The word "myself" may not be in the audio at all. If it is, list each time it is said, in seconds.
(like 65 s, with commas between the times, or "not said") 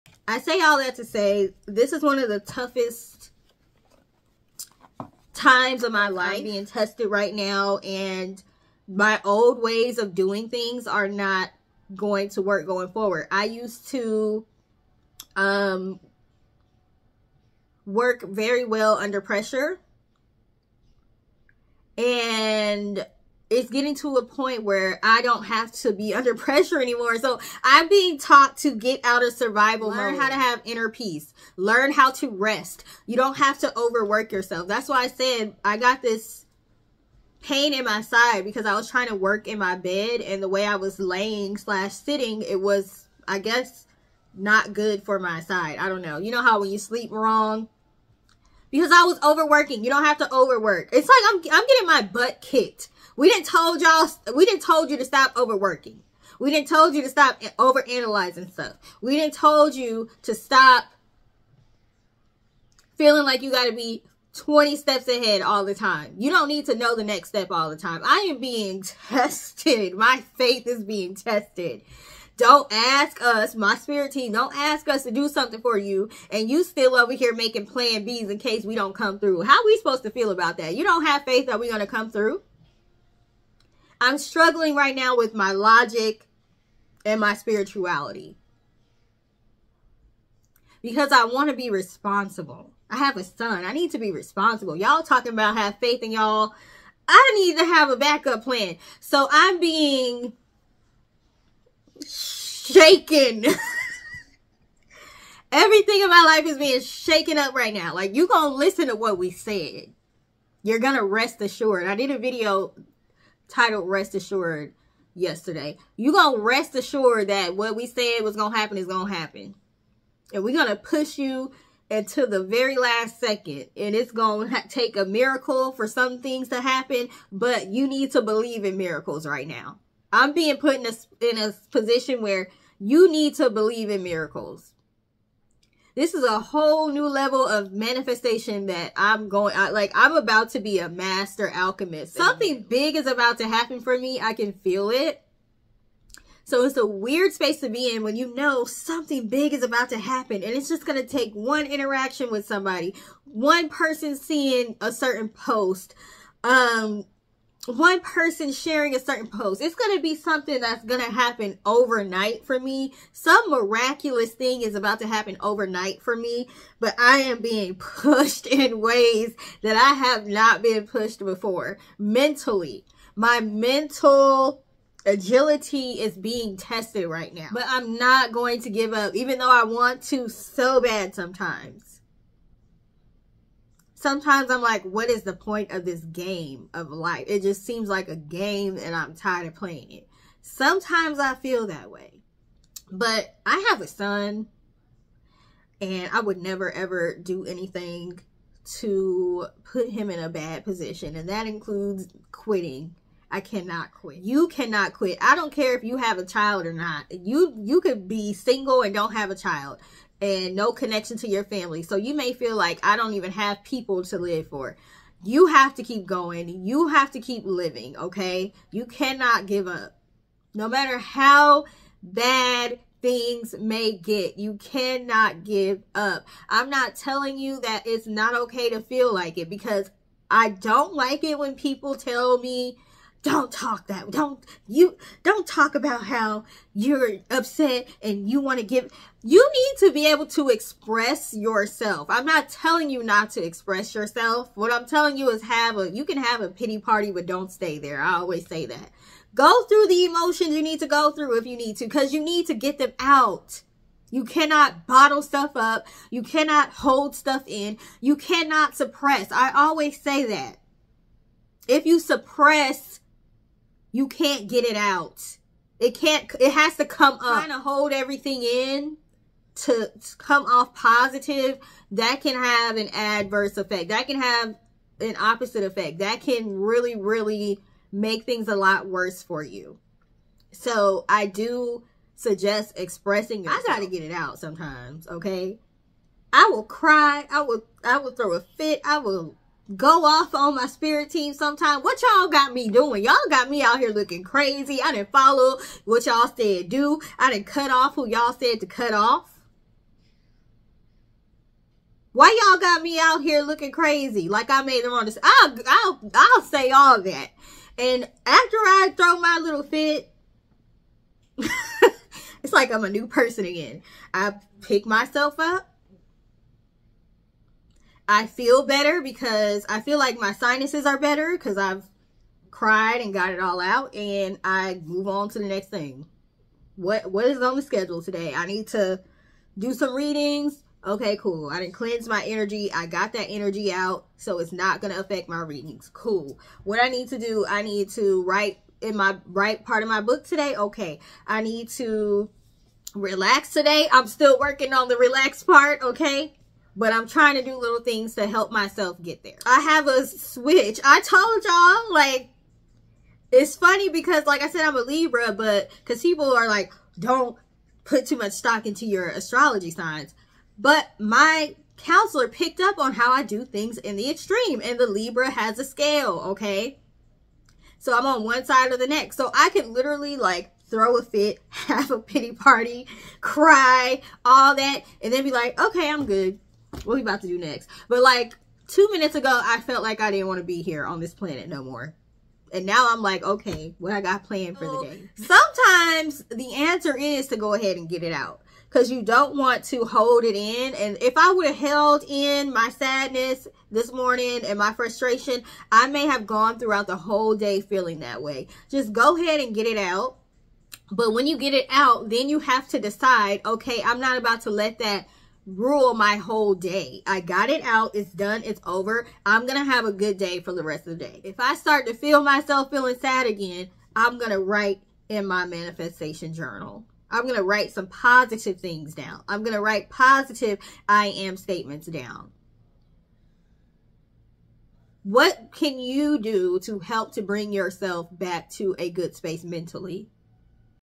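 314 s, 348 s, 412 s.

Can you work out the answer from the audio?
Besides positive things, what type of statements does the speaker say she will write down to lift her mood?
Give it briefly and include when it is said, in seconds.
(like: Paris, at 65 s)
I am statements, at 420 s.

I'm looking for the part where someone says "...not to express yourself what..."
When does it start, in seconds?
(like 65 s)
243 s.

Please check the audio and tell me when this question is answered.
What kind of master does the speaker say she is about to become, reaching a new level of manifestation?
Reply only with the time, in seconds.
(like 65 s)
140 s.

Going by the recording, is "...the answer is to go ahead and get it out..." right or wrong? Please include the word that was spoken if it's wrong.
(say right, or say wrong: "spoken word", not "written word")
right.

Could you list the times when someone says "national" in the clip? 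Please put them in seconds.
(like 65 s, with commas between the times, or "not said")
not said.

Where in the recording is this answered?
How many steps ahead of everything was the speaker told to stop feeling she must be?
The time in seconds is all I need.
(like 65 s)
64 s.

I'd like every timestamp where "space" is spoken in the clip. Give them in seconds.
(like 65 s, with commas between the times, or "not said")
147 s, 429 s.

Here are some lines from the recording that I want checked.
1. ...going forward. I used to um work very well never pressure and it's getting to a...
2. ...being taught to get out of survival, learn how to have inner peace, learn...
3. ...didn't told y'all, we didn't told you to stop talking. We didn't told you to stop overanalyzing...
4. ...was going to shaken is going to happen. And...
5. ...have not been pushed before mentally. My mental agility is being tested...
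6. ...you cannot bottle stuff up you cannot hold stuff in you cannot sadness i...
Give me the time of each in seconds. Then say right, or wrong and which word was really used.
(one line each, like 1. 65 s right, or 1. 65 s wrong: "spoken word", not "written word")
1. 12 s wrong: "under", not "never"
2. 27 s right
3. 53 s wrong: "overworking", not "talking"
4. 118 s wrong: "happen", not "shaken"
5. 169 s right
6. 254 s wrong: "suppress", not "sadness".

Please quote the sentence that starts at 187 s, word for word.
It just seems like a game and I'm tired of playing it.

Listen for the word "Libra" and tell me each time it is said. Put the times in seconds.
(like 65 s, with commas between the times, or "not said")
354 s, 364 s.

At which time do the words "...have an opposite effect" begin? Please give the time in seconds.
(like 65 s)
274 s.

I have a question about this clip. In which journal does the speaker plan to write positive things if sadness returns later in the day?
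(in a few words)
manifestation journal.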